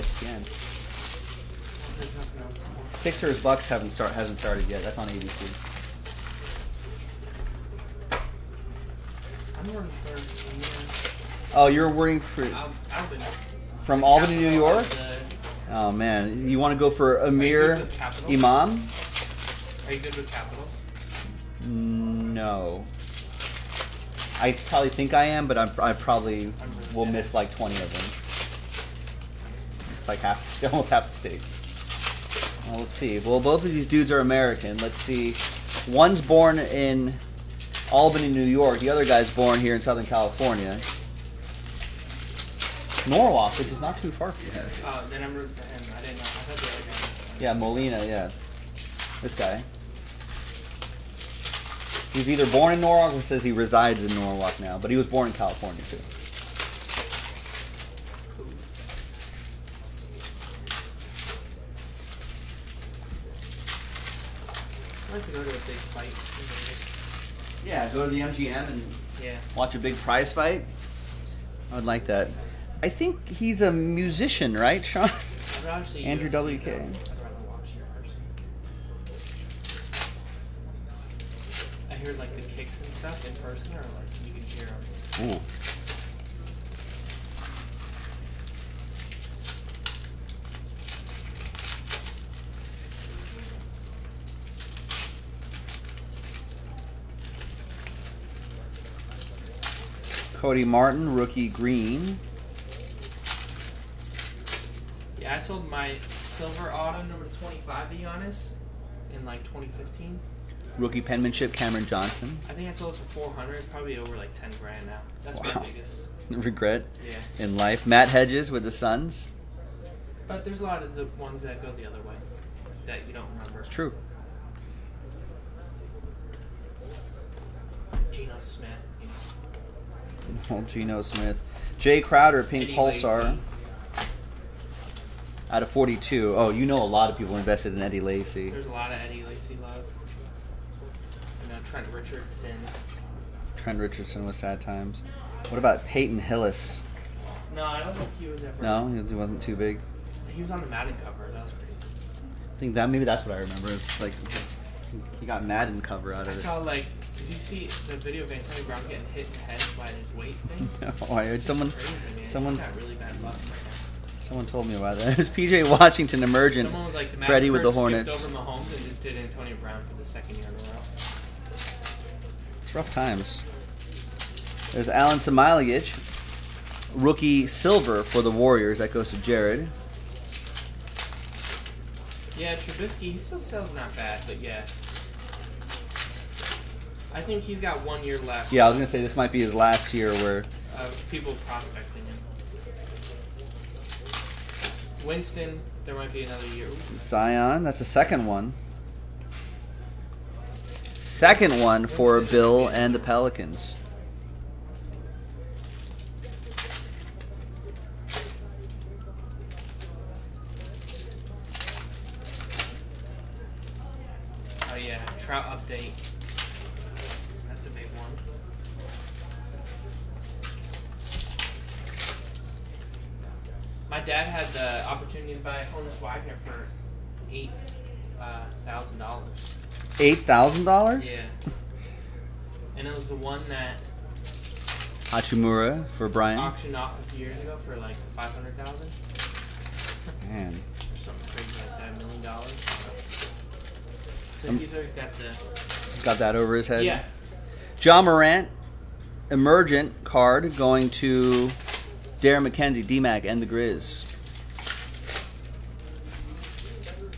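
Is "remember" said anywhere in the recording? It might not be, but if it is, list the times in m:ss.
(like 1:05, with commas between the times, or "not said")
2:03, 2:33.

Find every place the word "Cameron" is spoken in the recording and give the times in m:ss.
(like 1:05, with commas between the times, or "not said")
1:51.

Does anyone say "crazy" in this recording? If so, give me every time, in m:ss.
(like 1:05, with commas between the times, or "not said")
2:31, 2:41, 4:01.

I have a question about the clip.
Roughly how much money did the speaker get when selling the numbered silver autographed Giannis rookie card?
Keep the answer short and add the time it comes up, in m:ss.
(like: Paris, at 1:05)
400, at 1:53.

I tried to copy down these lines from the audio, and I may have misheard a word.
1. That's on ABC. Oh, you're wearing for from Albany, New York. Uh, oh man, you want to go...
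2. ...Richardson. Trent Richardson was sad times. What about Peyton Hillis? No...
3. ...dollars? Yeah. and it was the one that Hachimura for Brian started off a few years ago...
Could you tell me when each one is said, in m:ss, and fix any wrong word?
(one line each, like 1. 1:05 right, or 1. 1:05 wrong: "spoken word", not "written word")
1. 0:04 right
2. 2:21 right
3. 3:50 wrong: "auctioned", not "started".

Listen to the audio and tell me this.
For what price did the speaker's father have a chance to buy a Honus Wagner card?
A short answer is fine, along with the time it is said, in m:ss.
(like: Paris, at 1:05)
$8,000, at 3:47.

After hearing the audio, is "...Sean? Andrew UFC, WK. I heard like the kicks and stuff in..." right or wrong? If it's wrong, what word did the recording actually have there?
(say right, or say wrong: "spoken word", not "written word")
right.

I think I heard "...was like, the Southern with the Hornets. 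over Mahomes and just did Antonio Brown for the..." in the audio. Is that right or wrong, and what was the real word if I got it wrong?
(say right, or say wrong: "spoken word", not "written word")
wrong: "Freddie", not "Southern".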